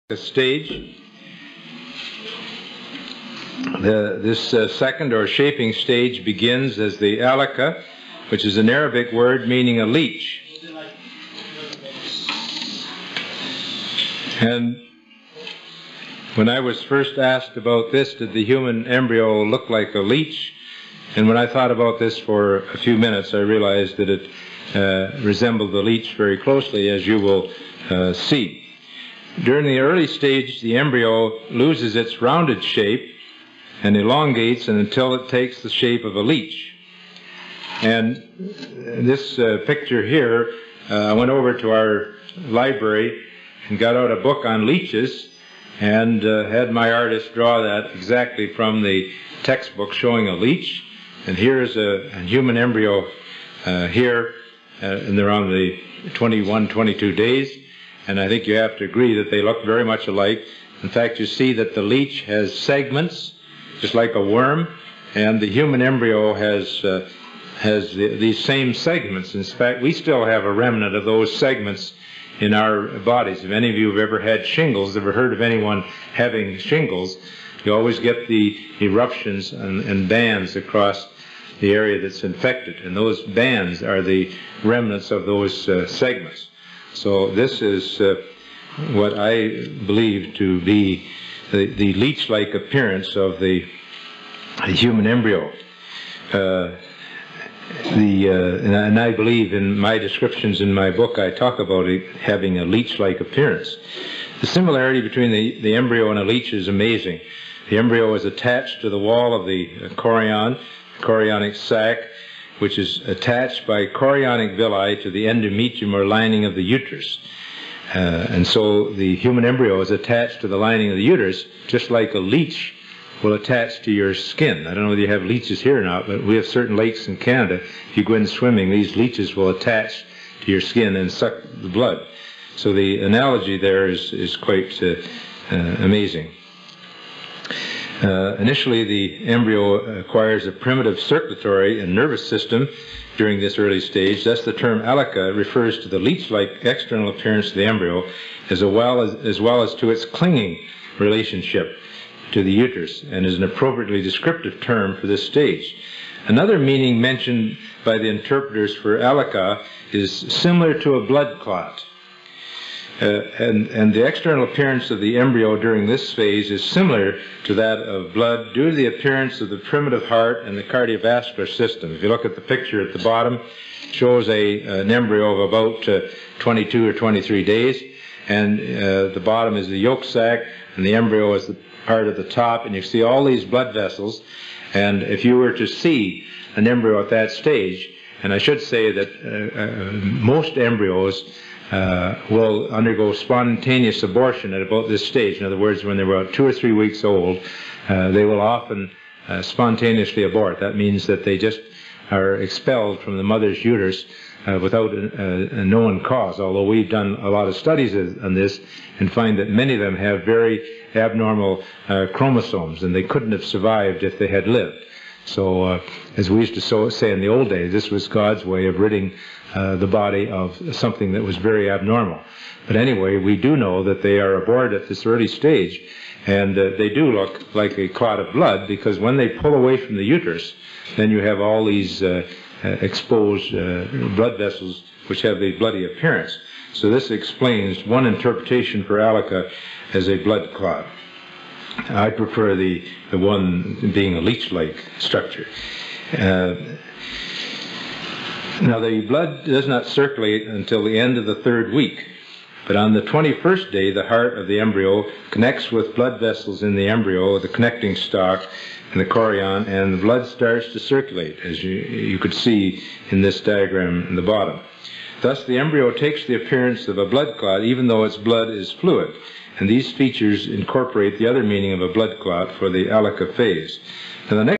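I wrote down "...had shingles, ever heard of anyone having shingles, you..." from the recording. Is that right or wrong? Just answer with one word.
right.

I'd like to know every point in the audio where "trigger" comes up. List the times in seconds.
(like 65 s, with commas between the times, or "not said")
not said.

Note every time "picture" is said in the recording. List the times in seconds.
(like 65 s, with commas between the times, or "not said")
39 s, 172 s.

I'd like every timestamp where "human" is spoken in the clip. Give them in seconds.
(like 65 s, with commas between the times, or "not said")
18 s, 52 s, 65 s, 94 s, 119 s.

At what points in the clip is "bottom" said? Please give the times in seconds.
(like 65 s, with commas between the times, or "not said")
173 s, 179 s, 264 s.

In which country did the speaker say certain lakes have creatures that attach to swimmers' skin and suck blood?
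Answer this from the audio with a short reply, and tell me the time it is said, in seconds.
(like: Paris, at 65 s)
Canada, at 127 s.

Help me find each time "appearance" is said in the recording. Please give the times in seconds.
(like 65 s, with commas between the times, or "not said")
92 s, 103 s, 147 s, 164 s, 168 s, 235 s, 266 s.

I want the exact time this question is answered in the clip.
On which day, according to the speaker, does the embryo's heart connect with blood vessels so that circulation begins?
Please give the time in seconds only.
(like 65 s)
253 s.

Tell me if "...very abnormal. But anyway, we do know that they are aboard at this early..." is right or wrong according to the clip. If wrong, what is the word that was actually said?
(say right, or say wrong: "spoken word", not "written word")
right.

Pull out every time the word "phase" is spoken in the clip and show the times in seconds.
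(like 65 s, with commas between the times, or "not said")
166 s, 273 s.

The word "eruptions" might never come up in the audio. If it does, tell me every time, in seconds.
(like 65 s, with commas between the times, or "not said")
78 s.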